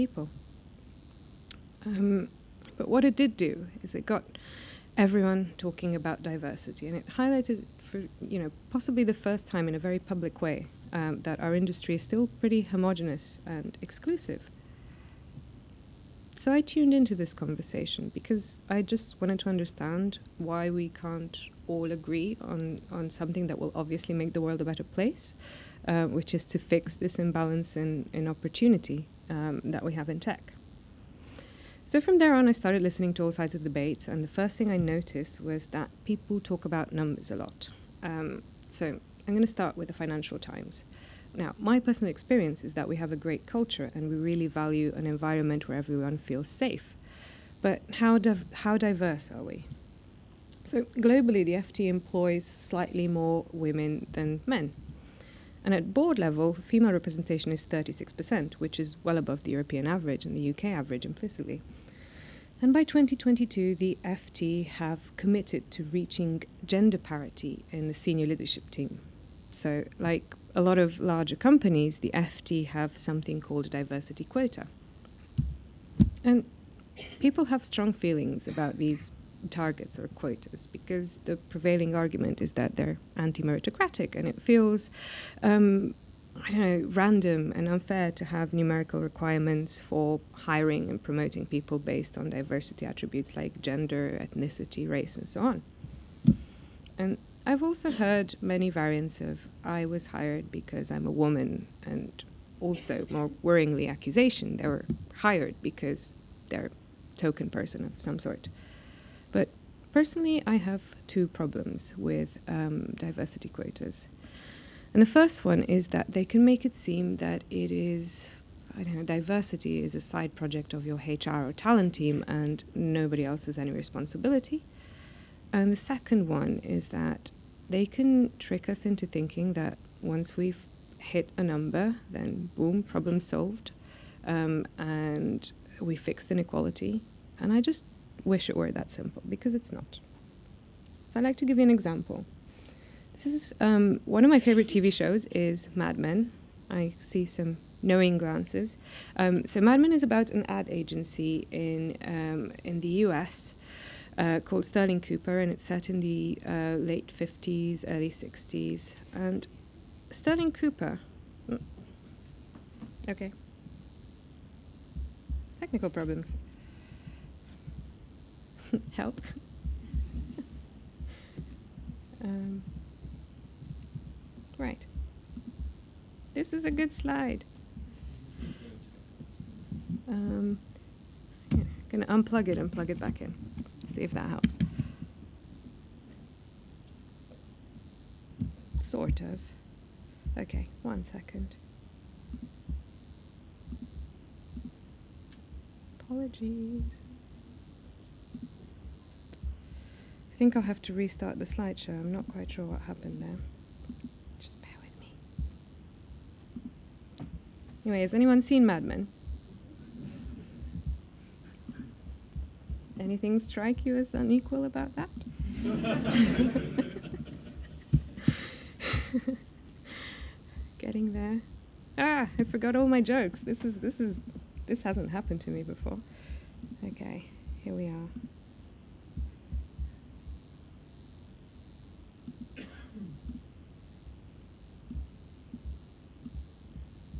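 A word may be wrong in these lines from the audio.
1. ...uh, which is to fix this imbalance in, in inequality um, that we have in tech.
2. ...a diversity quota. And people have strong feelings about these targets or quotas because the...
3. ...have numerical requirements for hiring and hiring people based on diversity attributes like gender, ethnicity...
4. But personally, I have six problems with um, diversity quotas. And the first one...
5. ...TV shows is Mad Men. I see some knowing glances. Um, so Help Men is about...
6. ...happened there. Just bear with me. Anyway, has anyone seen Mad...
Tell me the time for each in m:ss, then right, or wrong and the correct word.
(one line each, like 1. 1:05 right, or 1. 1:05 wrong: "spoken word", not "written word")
1. 0:25 wrong: "opportunity", not "inequality"
2. 1:13 right
3. 1:28 wrong: "promoting", not "hiring"
4. 1:49 wrong: "two", not "six"
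5. 2:24 wrong: "Mad", not "Help"
6. 3:22 right.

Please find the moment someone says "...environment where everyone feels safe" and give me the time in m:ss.
0:45.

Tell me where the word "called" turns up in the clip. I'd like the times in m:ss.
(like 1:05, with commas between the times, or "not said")
1:13, 2:34.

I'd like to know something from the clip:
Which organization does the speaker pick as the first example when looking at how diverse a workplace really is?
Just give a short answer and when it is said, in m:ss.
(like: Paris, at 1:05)
Financial Times, at 0:39.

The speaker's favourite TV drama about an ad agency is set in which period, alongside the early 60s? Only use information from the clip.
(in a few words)
late 50s.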